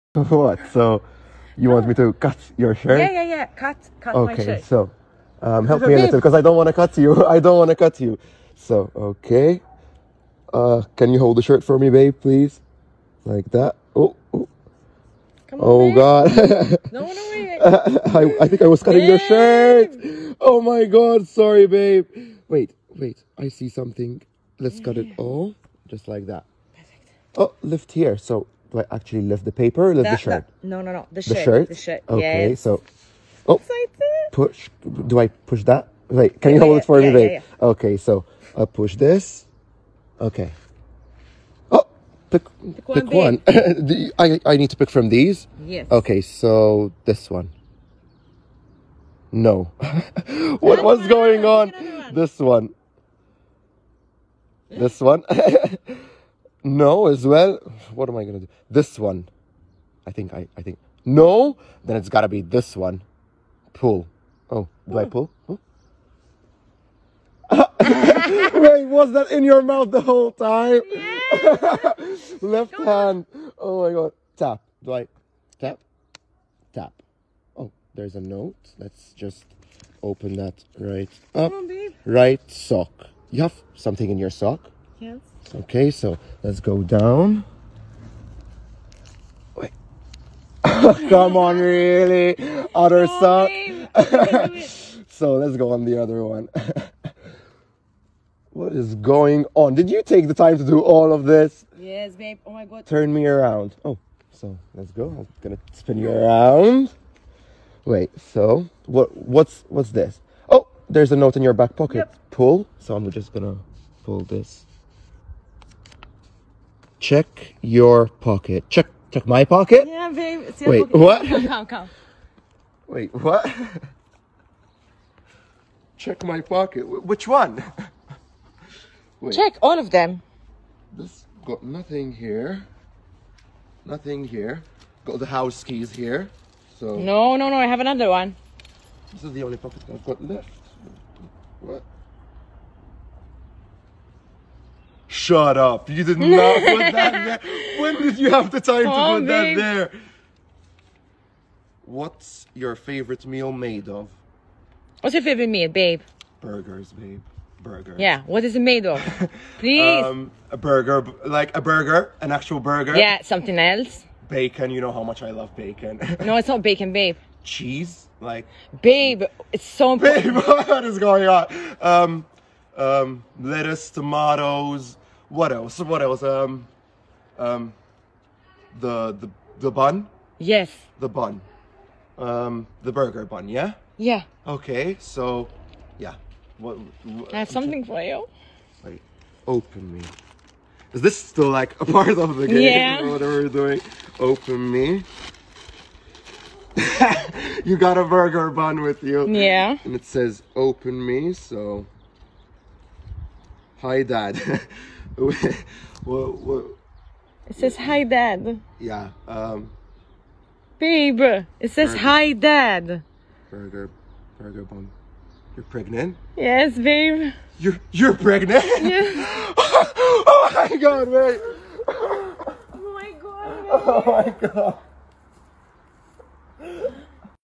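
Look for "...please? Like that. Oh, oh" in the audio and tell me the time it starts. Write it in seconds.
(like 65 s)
12 s.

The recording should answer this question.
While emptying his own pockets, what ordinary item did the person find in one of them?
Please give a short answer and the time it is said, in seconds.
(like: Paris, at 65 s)
house keys, at 135 s.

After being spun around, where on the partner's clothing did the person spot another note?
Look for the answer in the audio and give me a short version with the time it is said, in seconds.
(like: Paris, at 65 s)
back pocket, at 111 s.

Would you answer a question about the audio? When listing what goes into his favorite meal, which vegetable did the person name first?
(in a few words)
lettuce.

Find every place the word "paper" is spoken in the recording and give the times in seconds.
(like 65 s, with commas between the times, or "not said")
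29 s.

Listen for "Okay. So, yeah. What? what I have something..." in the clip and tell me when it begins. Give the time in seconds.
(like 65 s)
184 s.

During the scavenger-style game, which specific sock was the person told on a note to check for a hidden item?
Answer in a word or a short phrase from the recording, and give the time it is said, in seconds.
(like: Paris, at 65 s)
right sock, at 82 s.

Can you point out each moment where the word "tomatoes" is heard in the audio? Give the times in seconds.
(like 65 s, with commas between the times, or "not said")
173 s.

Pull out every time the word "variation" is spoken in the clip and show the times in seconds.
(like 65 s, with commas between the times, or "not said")
not said.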